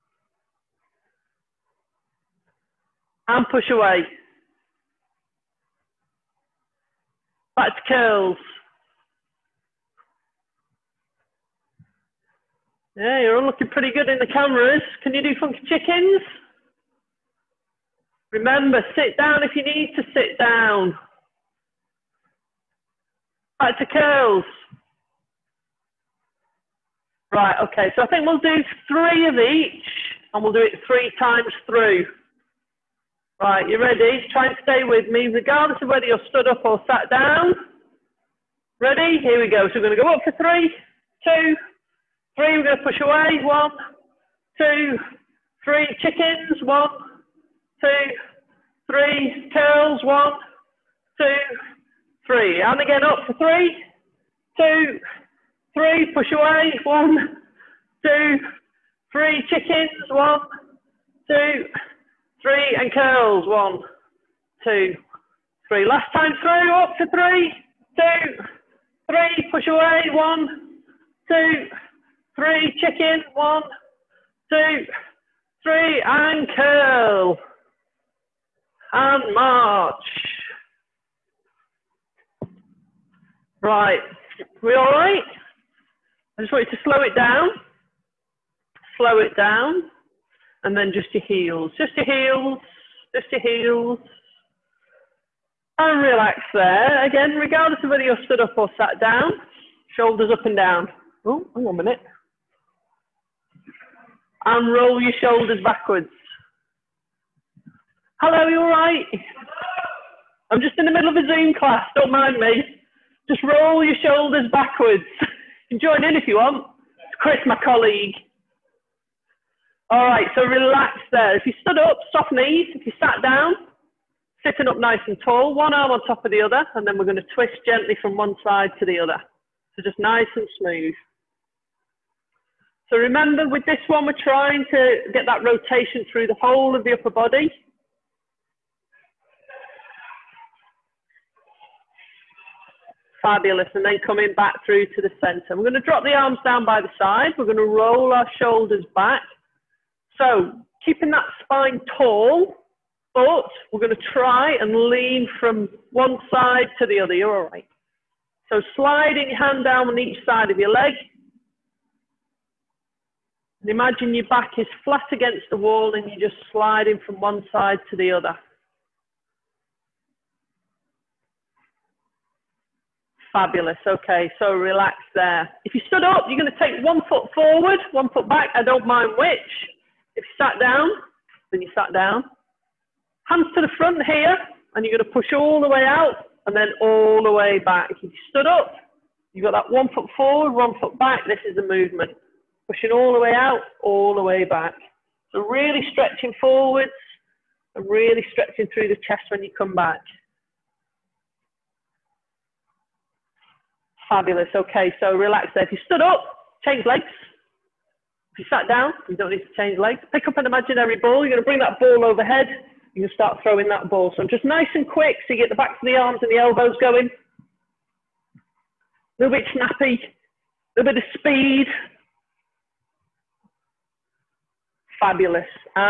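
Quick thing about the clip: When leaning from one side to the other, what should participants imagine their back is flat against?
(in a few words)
The wall.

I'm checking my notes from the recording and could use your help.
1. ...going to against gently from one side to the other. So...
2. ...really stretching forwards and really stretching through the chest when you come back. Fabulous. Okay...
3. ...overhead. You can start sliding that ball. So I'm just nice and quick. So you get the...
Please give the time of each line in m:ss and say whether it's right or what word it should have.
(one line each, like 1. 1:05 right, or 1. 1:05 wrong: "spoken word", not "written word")
1. 2:07 wrong: "twist", not "against"
2. 3:15 right
3. 3:32 wrong: "throwing", not "sliding".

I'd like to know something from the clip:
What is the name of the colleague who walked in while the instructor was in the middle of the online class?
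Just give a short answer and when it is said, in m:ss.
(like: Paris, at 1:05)
Chris, at 1:57.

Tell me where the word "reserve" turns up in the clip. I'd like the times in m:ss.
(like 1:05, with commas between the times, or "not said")
not said.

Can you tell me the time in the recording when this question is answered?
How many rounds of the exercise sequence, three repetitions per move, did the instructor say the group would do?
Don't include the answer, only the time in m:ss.
0:30.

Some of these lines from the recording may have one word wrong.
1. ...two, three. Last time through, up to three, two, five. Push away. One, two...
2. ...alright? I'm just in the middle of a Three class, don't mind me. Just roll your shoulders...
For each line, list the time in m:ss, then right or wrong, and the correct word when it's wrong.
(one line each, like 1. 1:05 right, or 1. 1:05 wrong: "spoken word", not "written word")
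1. 1:04 wrong: "three", not "five"
2. 1:48 wrong: "Zoom", not "Three".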